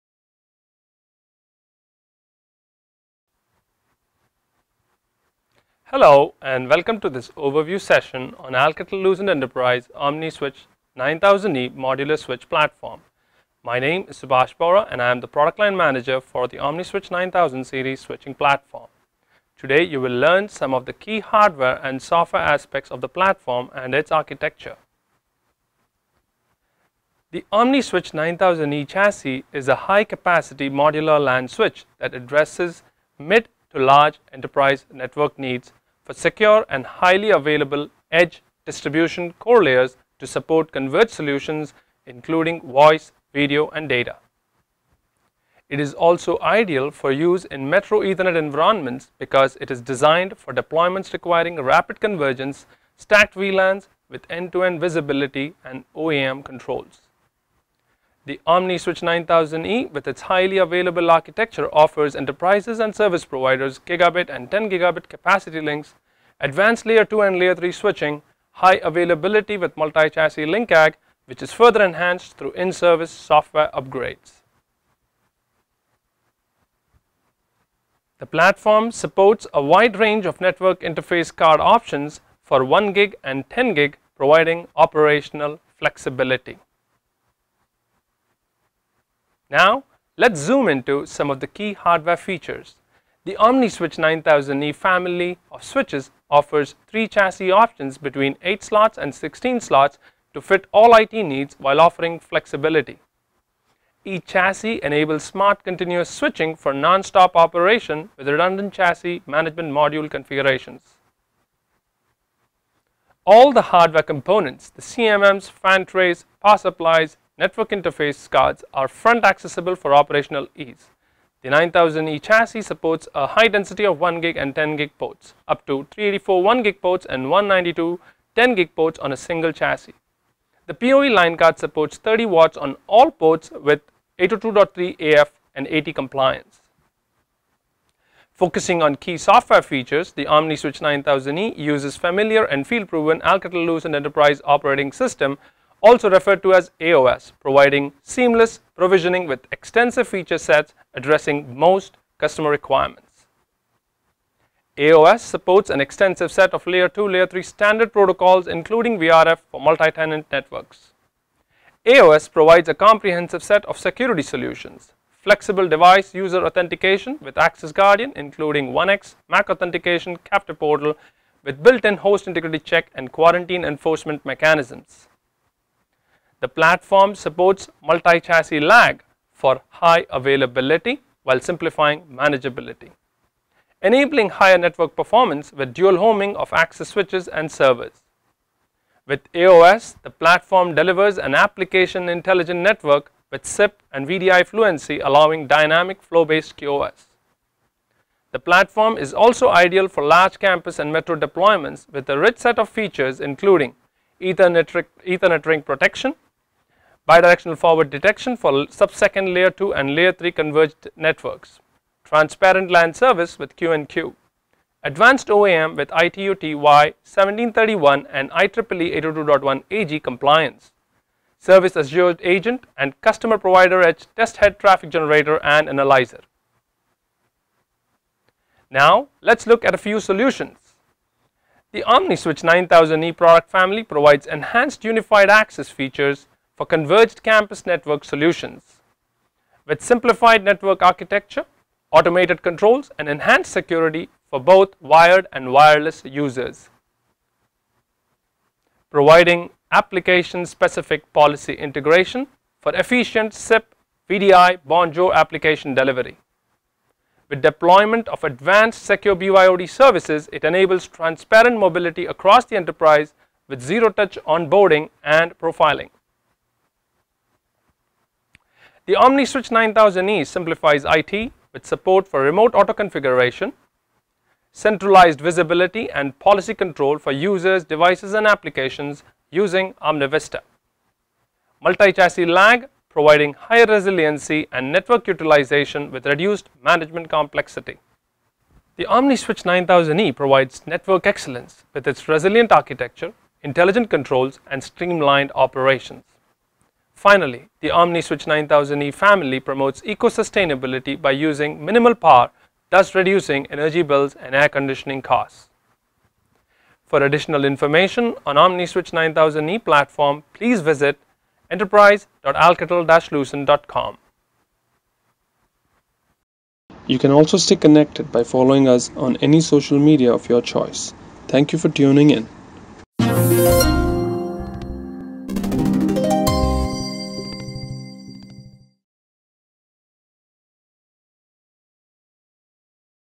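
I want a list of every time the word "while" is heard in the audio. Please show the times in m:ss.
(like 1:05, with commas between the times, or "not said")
1:41, 3:01.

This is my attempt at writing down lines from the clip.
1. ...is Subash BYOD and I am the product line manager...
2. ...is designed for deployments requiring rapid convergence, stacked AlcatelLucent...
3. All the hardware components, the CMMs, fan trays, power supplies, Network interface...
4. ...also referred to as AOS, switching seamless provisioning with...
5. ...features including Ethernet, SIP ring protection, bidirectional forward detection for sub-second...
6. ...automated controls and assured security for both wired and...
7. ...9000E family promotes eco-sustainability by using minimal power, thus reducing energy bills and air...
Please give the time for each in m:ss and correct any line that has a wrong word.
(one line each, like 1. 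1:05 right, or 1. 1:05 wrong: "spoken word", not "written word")
1. 0:14 wrong: "Bohra", not "BYOD"
2. 0:49 wrong: "VLANs", not "AlcatelLucent"
3. 1:53 right
4. 2:25 wrong: "providing", not "switching"
5. 3:22 wrong: "Ethernet", not "SIP"
6. 4:01 wrong: "enhanced", not "assured"
7. 4:58 right.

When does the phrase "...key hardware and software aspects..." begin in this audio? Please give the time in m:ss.
0:20.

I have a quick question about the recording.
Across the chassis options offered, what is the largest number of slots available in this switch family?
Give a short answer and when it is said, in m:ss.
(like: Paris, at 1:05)
16, at 1:39.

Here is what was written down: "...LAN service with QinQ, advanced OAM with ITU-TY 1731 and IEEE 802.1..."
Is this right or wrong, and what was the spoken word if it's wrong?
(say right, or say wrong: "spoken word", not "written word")
right.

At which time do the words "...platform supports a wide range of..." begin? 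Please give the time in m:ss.
1:18.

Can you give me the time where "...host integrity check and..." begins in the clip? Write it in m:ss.
2:51.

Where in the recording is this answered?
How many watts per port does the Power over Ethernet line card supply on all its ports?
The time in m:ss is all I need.
2:11.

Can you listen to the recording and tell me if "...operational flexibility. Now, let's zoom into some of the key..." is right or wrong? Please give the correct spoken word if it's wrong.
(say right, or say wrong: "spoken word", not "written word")
right.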